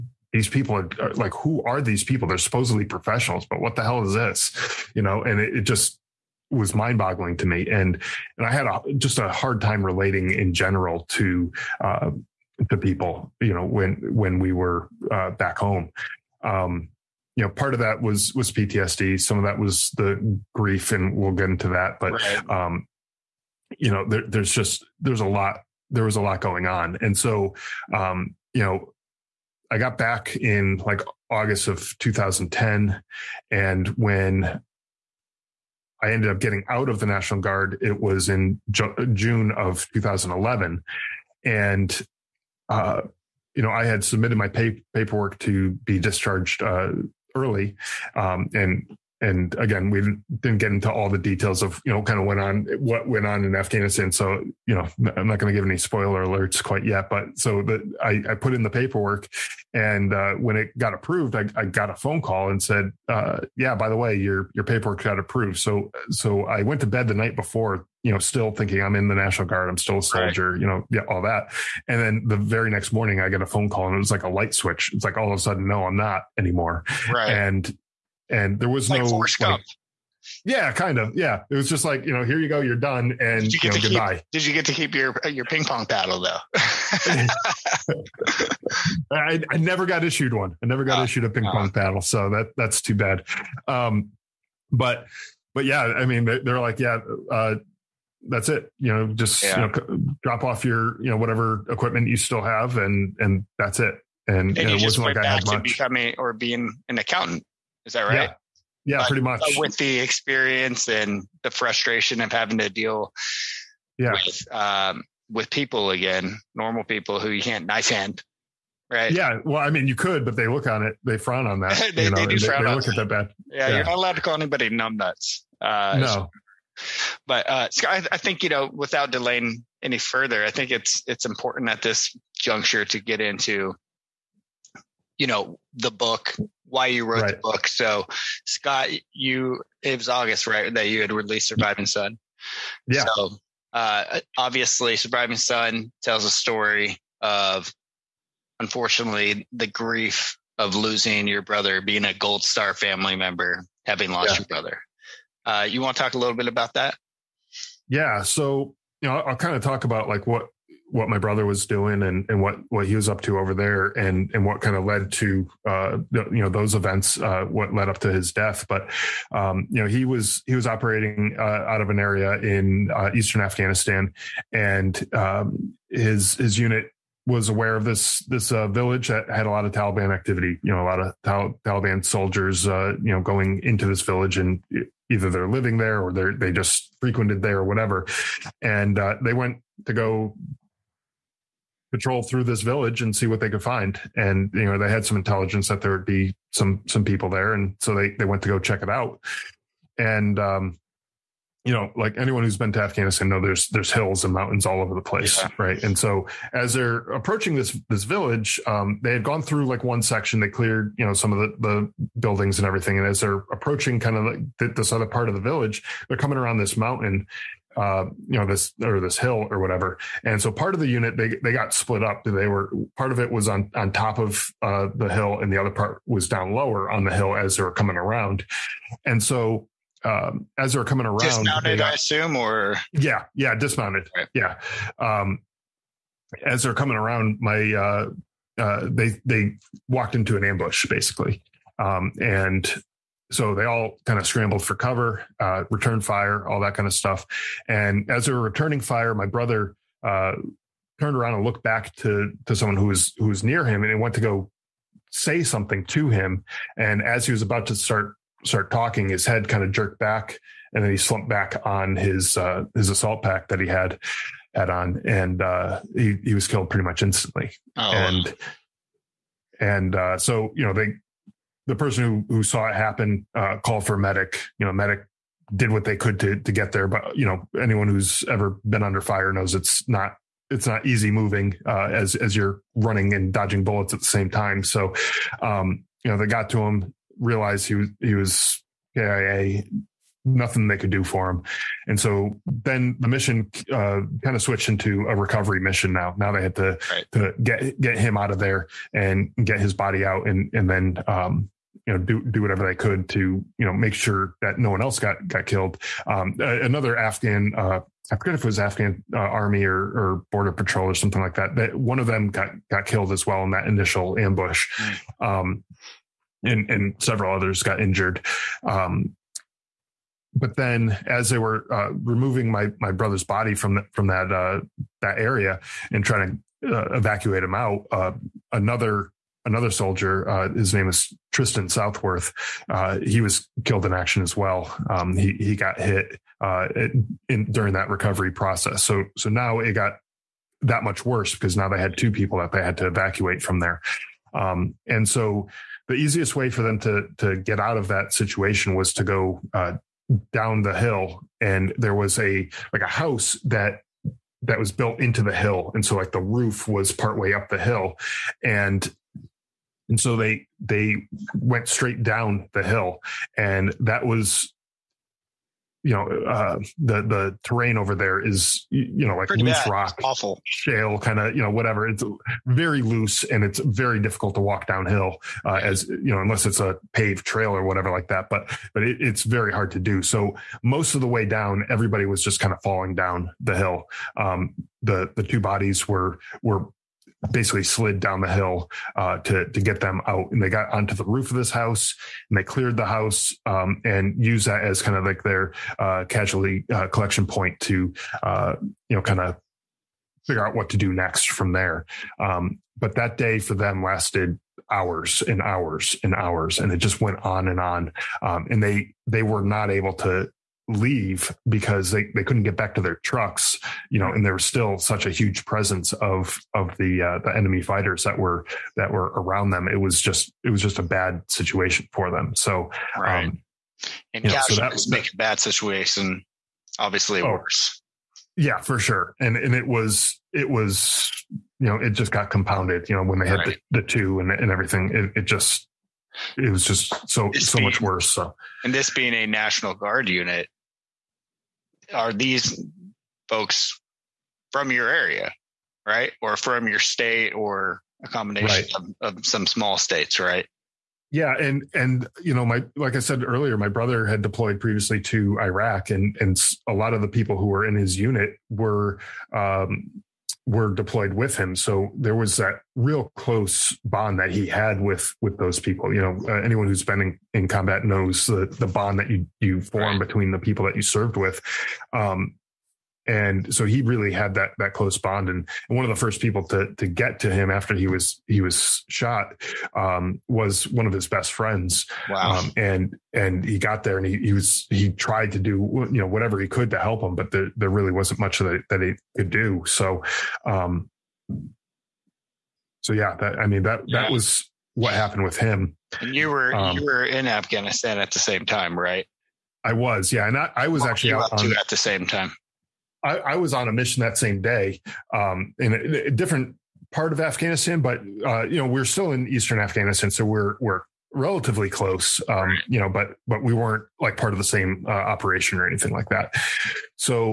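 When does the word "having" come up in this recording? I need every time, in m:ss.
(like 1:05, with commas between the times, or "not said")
1:52, 2:33.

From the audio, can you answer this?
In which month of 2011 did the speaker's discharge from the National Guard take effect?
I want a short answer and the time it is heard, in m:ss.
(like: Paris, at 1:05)
June, at 0:39.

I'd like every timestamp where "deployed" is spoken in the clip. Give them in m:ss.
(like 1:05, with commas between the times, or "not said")
7:34, 7:40.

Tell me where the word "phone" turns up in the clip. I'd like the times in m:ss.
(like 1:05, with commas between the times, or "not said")
1:01, 1:13.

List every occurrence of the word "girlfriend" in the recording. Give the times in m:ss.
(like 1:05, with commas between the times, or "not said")
not said.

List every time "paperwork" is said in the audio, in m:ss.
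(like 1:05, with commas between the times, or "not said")
0:44, 0:58, 1:04.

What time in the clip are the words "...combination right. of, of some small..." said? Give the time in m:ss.
7:28.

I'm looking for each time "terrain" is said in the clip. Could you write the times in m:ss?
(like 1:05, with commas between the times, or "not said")
6:07.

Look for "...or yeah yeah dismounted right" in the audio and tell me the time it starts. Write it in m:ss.
3:52.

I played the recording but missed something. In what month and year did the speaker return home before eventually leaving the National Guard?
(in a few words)
August 2010.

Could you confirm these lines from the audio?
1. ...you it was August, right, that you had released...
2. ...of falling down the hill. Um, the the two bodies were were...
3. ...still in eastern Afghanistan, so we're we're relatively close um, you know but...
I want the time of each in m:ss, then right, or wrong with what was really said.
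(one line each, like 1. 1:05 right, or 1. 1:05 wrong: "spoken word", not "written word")
1. 2:19 right
2. 6:22 right
3. 8:28 right.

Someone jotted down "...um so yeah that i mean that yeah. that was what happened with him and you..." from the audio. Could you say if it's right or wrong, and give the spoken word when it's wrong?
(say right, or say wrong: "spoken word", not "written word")
right.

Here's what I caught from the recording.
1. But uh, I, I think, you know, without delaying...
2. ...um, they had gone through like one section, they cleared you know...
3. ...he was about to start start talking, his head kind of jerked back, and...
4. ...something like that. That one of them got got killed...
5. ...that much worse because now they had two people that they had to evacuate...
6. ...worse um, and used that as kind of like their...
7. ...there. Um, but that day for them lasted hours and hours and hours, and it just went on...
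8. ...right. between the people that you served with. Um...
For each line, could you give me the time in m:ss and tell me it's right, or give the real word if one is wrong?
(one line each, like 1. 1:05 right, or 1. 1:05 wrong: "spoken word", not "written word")
1. 2:07 right
2. 3:28 right
3. 4:17 right
4. 5:10 right
5. 5:40 right
6. 6:32 wrong: "house", not "worse"
7. 6:41 right
8. 7:49 right.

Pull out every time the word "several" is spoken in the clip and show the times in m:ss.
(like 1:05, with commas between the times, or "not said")
5:17.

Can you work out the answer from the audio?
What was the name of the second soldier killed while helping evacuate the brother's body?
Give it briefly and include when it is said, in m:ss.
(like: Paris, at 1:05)
Tristan Southworth, at 5:31.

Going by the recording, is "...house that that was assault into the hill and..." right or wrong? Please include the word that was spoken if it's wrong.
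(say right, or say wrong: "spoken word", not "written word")
wrong: "built", not "assault".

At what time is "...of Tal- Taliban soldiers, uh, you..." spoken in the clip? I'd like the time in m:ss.
3:00.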